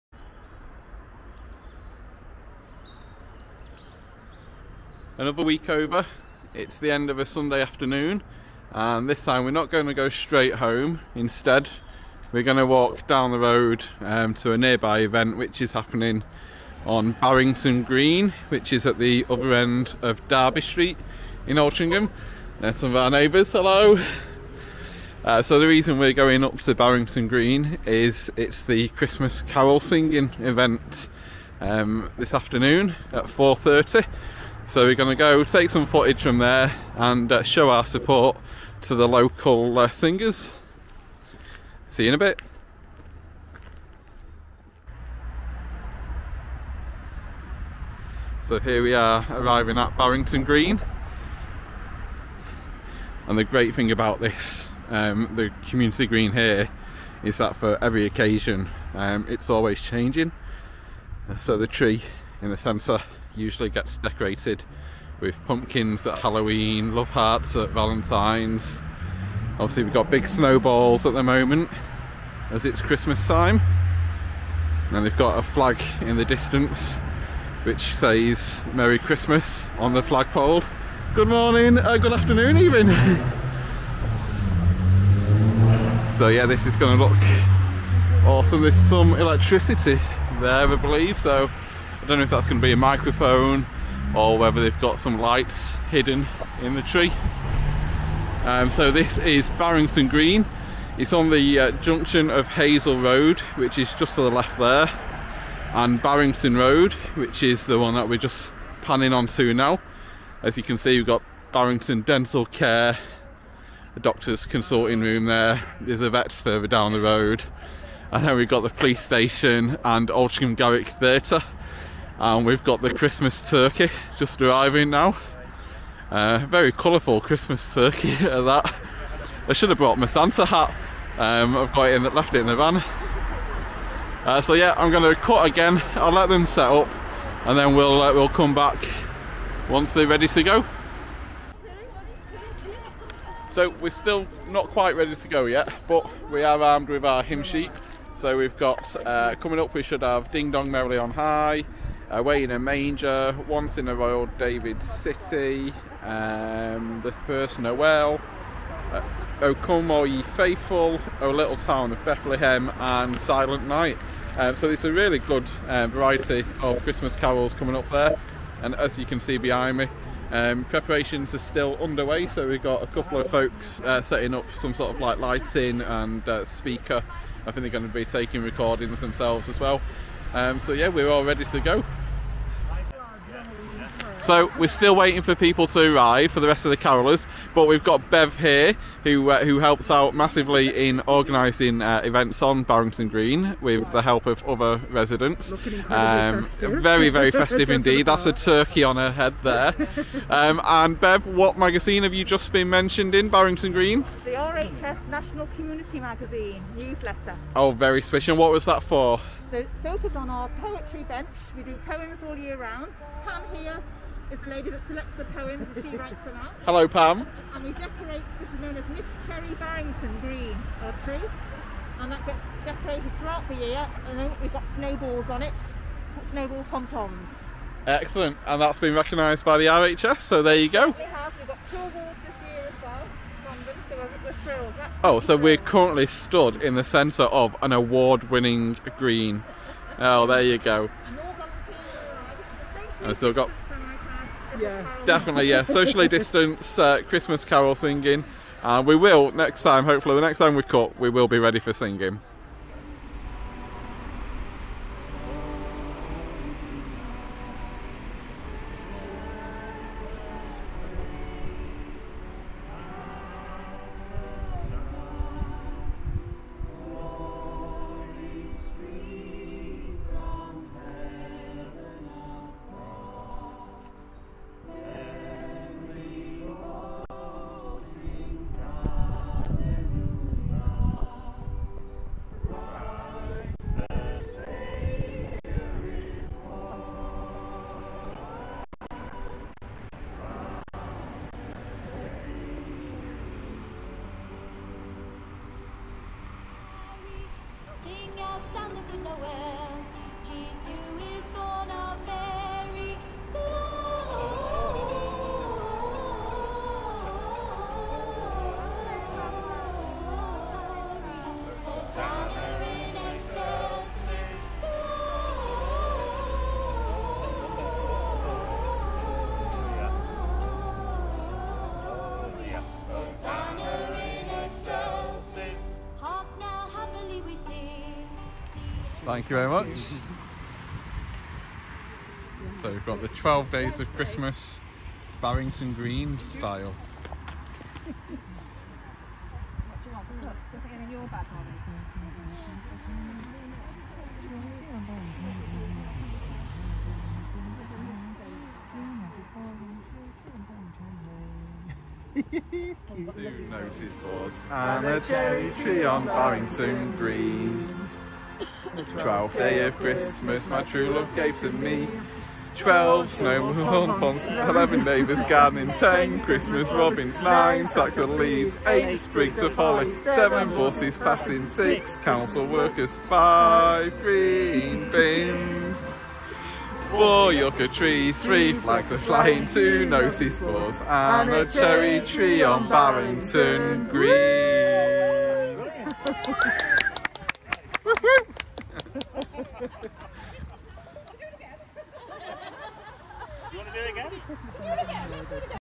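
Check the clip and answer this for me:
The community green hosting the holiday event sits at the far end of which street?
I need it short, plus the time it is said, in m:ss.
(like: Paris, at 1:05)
Derby Street, at 0:20.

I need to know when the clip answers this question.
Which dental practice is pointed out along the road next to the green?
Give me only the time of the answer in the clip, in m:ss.
1:51.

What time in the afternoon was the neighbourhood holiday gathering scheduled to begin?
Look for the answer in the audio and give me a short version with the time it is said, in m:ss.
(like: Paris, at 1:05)
4:30, at 0:33.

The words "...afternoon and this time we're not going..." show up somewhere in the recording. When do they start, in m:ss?
0:07.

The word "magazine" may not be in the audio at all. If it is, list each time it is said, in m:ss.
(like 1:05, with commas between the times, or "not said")
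3:21, 3:25.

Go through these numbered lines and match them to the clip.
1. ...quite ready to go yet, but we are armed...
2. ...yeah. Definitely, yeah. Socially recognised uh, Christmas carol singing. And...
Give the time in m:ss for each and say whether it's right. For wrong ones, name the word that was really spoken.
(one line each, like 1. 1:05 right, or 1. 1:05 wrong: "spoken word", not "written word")
1. 2:24 right
2. 4:04 wrong: "distanced", not "recognised".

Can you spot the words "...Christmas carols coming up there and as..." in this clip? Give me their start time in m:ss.
2:46.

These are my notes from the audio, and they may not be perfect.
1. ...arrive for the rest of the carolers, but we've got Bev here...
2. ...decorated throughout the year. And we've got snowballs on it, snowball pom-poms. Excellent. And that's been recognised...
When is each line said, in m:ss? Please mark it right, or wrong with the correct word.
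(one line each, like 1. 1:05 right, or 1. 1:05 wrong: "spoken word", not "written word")
1. 3:05 right
2. 3:42 right.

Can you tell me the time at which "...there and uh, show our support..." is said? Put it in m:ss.
0:36.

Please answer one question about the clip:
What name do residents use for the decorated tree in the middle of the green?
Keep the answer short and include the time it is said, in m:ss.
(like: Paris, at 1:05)
Miss Cherry, at 3:38.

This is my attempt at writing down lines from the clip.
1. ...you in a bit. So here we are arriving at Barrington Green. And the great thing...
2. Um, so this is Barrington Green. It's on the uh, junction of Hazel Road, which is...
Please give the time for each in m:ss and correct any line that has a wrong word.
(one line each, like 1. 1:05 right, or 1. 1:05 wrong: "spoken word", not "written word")
1. 0:42 right
2. 1:38 right.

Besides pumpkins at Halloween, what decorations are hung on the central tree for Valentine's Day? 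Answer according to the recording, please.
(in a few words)
Love hearts.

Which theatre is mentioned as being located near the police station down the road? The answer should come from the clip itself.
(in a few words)
Altrincham Garrick Theatre.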